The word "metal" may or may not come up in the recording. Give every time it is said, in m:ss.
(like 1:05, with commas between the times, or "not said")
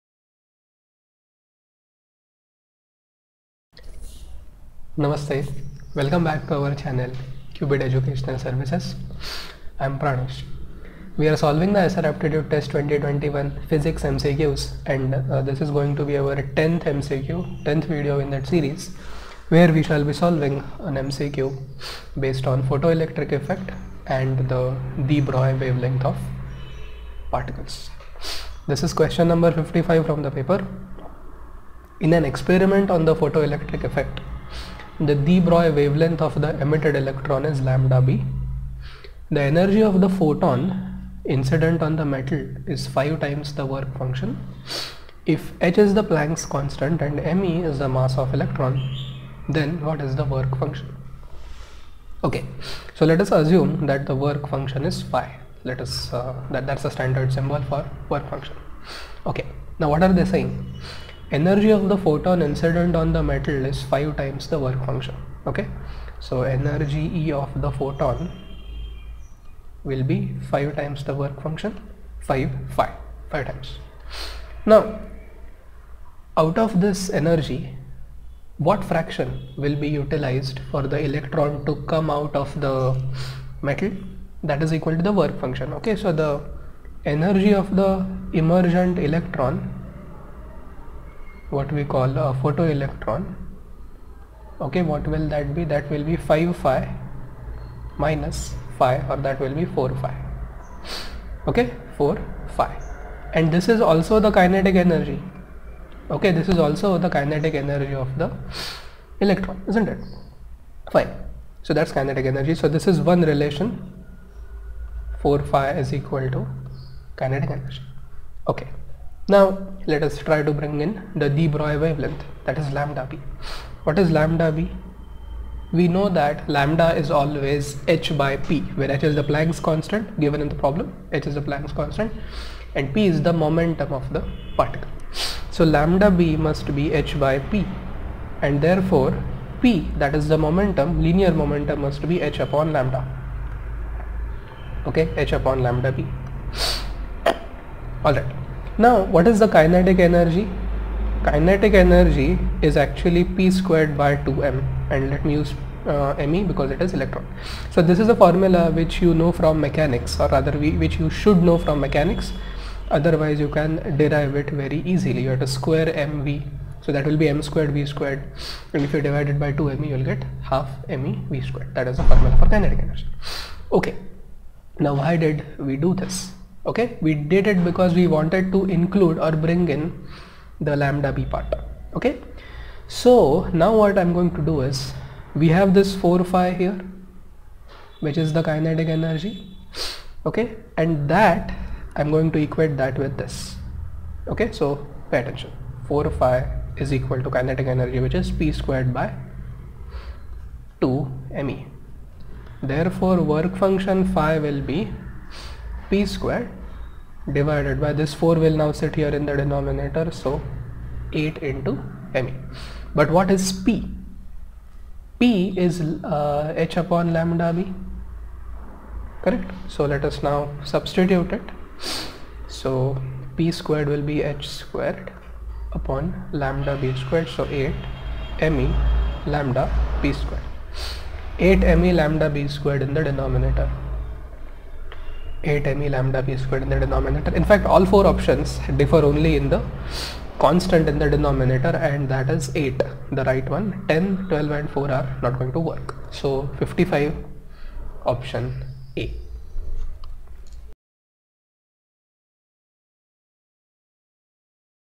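0:42, 1:03, 1:23.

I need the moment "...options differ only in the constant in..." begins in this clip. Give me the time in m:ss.
3:58.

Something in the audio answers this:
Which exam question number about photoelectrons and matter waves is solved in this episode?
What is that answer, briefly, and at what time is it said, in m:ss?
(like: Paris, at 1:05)
55, at 0:28.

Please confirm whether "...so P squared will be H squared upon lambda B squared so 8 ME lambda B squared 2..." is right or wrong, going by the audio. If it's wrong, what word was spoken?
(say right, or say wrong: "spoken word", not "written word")
wrong: "8", not "2".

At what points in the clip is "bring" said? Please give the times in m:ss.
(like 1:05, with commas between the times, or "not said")
2:00, 2:59.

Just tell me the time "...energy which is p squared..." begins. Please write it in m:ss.
3:17.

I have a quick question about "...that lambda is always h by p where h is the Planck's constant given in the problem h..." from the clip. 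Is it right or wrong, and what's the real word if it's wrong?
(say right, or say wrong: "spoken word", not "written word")
right.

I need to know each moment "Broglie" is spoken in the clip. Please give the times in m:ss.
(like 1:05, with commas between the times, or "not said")
0:25, 0:35, 2:01.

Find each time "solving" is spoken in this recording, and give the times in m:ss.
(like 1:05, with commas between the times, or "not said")
0:11, 0:20.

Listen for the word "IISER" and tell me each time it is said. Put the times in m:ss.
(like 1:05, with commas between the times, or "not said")
0:11.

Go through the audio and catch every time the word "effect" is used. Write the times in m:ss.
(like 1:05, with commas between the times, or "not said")
0:23, 0:33.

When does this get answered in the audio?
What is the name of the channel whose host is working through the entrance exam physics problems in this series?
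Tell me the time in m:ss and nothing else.
0:07.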